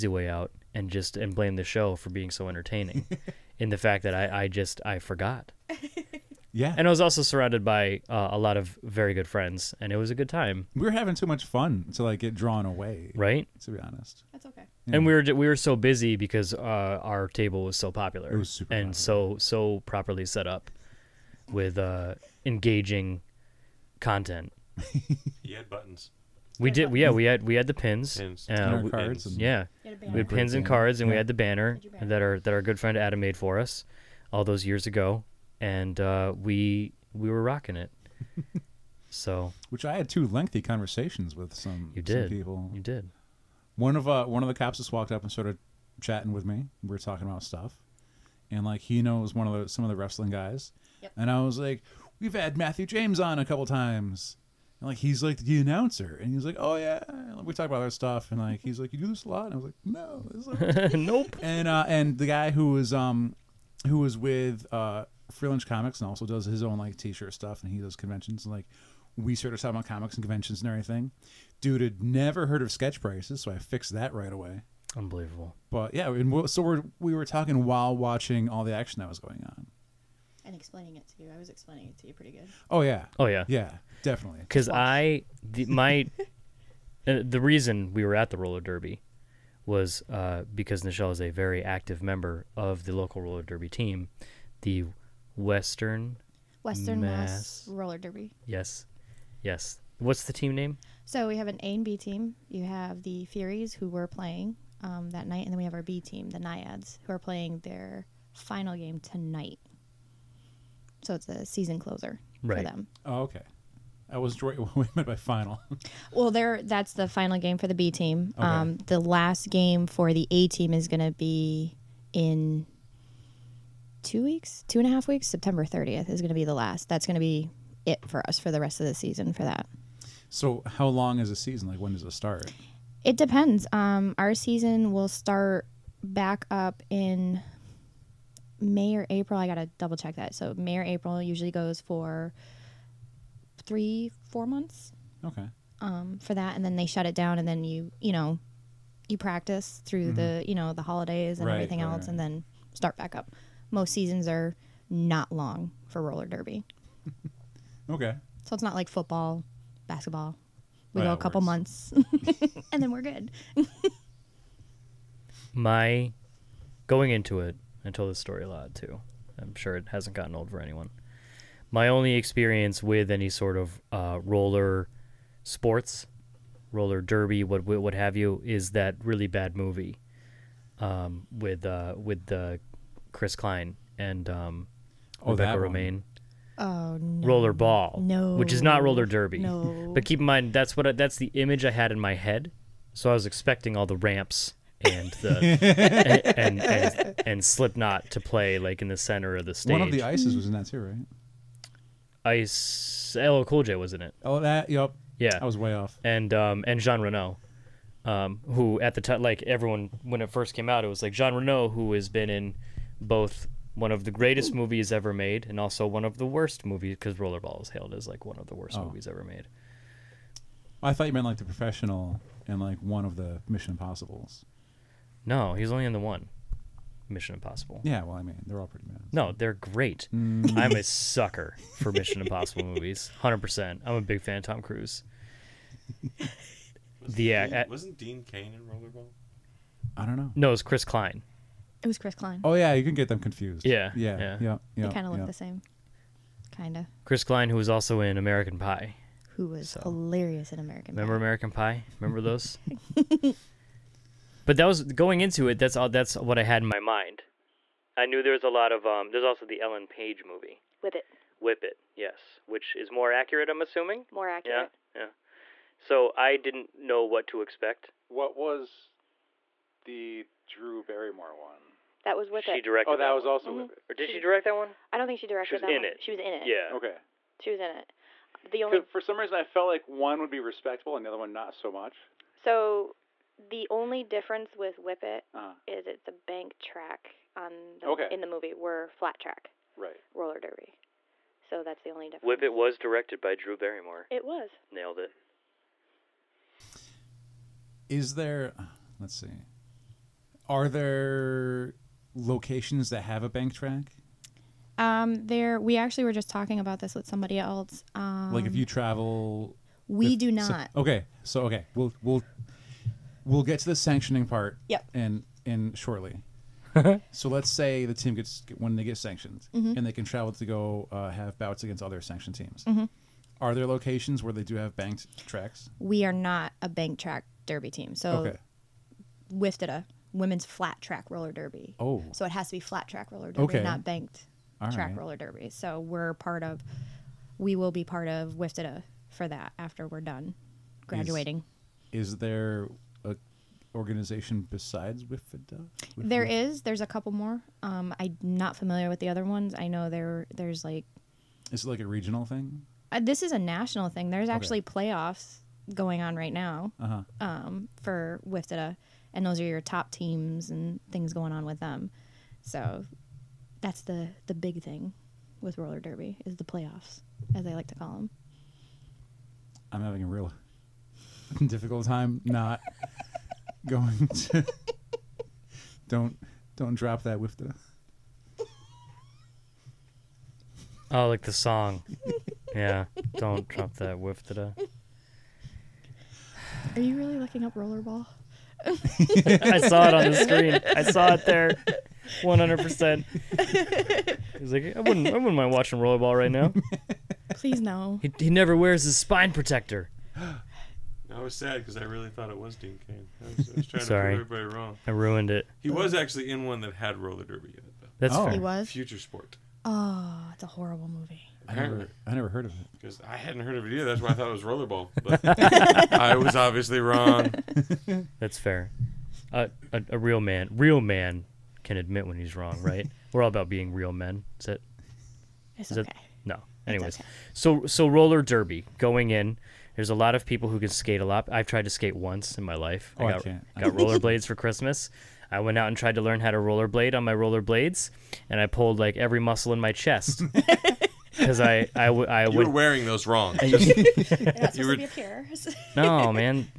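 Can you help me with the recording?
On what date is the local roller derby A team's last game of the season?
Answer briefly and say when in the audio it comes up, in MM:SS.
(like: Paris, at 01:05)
September 30th, at 02:05.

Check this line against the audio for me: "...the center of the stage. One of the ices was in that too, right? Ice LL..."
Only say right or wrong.
right.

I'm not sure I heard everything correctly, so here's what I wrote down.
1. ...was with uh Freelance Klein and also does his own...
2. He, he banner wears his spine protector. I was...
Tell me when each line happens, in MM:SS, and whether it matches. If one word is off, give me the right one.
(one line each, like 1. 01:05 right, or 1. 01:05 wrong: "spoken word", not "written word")
1. 01:03 wrong: "Comics", not "Klein"
2. 06:38 wrong: "never", not "banner".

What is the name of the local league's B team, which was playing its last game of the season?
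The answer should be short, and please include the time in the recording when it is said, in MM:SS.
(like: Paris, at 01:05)
The Naiads, at 01:46.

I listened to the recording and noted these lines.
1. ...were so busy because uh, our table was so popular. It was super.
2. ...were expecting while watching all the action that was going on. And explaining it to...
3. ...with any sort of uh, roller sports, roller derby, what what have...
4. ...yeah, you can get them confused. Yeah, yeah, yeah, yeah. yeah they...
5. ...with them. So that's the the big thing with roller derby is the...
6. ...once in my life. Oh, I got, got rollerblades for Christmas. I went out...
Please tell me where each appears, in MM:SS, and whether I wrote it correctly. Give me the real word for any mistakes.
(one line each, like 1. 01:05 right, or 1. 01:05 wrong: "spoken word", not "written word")
1. 00:15 right
2. 01:17 wrong: "talking", not "expecting"
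3. 02:52 right
4. 04:02 right
5. 06:01 right
6. 07:11 right.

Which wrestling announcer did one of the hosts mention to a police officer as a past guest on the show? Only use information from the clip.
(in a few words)
Matthew James.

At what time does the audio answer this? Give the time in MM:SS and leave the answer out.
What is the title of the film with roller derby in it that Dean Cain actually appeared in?
06:48.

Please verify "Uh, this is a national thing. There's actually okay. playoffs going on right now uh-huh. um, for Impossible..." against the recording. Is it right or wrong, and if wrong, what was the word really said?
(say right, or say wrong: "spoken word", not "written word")
wrong: "WFTDA", not "Impossible".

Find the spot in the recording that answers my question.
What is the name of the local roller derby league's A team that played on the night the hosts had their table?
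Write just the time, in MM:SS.
01:43.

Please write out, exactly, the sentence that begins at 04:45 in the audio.
it's a bank track on the, Okay.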